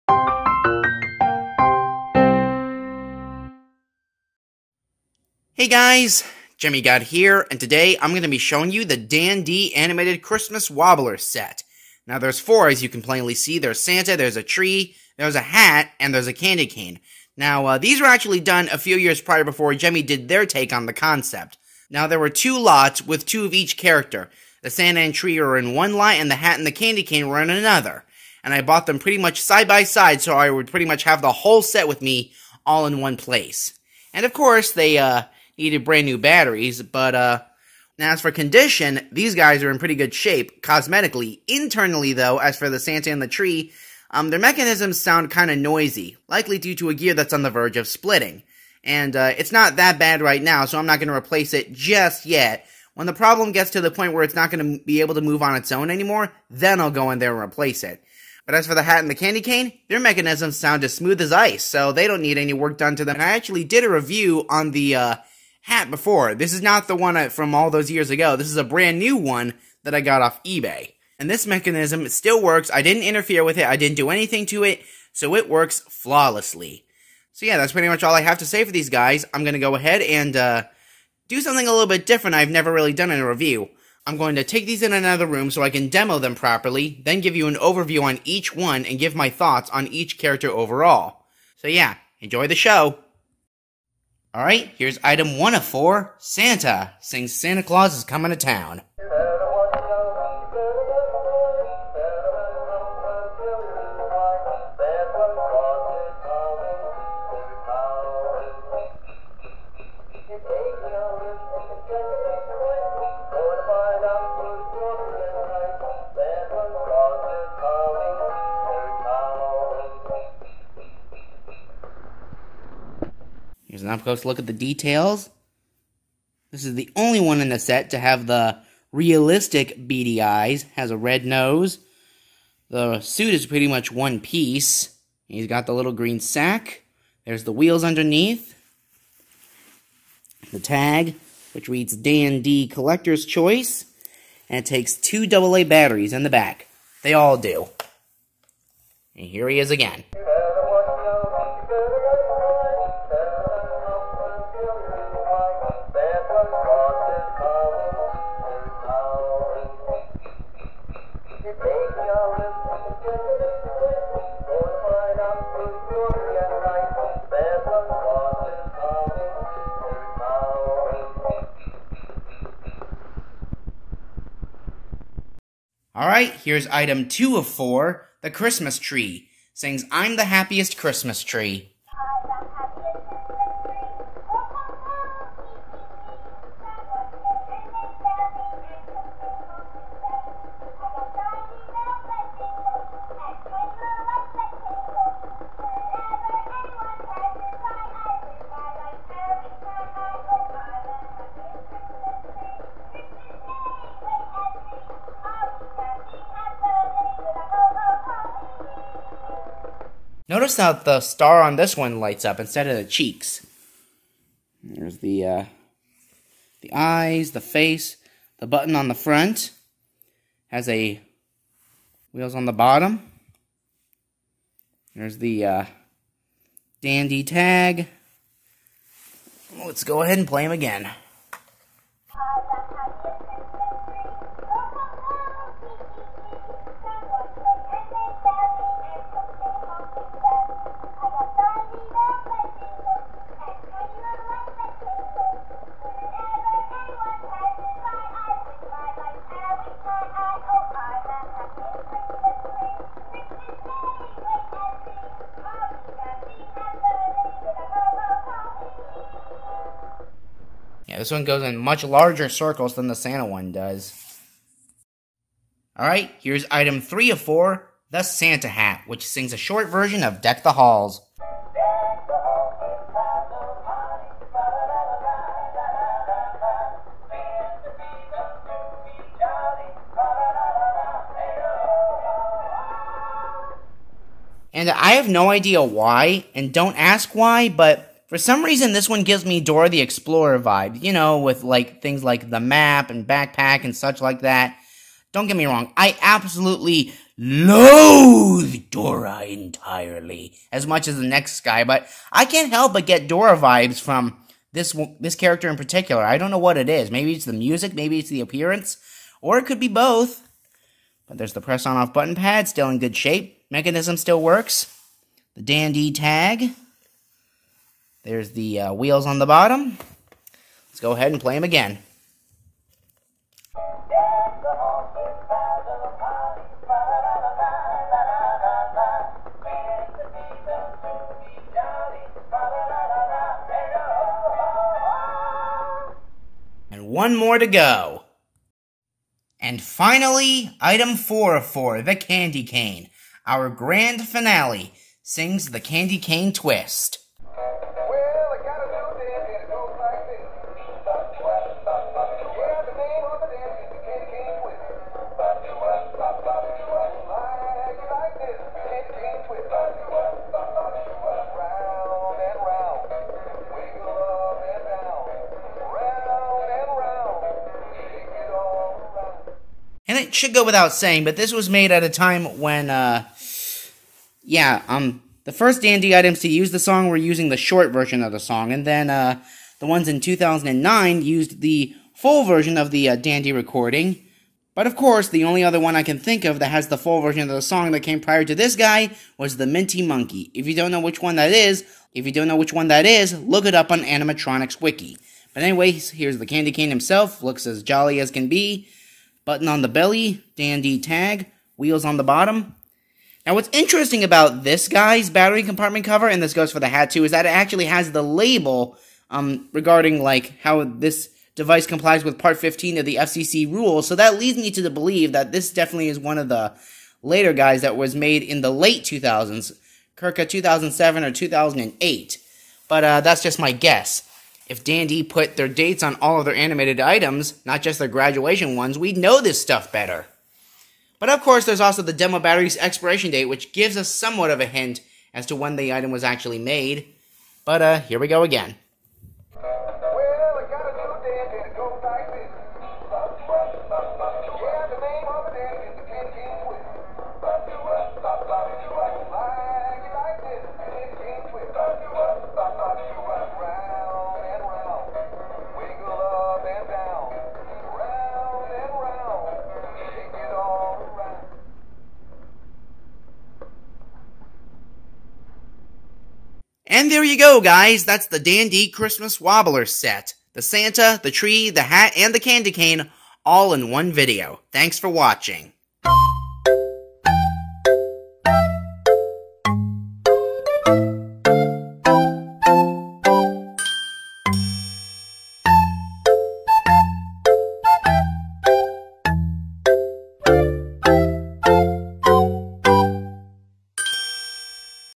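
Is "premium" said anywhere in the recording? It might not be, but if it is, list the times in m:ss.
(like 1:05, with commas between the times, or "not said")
not said.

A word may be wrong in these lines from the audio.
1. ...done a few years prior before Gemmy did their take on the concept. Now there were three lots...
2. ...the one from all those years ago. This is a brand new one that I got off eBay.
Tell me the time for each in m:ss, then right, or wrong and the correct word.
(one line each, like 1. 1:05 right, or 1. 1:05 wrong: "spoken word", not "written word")
1. 0:18 wrong: "two", not "three"
2. 1:06 right.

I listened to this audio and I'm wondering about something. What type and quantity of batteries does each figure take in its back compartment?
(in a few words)
2 AA.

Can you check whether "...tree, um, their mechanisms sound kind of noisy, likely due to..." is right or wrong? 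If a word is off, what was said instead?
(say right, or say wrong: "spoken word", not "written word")
right.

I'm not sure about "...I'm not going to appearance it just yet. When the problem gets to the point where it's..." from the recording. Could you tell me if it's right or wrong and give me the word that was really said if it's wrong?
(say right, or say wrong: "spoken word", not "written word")
wrong: "replace", not "appearance".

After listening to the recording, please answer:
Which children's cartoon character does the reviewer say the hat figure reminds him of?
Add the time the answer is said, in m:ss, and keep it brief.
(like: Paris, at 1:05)
Dora the Explorer, at 4:49.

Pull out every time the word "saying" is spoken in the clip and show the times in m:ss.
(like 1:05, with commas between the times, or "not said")
6:10.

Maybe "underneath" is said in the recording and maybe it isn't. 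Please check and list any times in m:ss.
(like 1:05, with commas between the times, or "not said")
2:17.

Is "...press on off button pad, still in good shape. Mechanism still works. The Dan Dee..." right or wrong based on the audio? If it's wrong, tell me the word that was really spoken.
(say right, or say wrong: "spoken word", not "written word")
right.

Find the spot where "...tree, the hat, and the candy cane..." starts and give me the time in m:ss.
7:51.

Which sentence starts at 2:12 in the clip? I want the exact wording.
The suit is pretty much one piece.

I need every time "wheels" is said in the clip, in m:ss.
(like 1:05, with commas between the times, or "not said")
2:17, 3:42, 5:18, 6:41.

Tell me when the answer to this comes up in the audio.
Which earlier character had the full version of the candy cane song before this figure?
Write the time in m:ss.
6:29.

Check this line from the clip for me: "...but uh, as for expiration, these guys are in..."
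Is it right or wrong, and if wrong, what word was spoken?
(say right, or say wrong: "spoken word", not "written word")
wrong: "condition", not "expiration".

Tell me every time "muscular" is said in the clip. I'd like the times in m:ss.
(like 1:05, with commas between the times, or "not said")
not said.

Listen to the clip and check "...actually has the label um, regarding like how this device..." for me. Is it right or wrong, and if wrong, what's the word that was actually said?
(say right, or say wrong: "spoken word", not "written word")
right.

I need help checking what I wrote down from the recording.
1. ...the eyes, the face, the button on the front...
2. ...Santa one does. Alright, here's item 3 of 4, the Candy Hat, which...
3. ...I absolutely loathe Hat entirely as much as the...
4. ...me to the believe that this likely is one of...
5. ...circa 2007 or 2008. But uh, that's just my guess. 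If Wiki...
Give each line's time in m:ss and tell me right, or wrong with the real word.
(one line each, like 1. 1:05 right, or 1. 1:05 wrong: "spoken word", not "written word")
1. 3:36 right
2. 4:22 wrong: "Santa", not "Candy"
3. 4:55 wrong: "Dora", not "Hat"
4. 6:54 wrong: "definitely", not "likely"
5. 6:59 wrong: "Dan", not "Wiki".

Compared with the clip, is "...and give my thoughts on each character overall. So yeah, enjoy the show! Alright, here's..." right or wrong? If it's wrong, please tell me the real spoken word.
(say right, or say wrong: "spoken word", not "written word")
right.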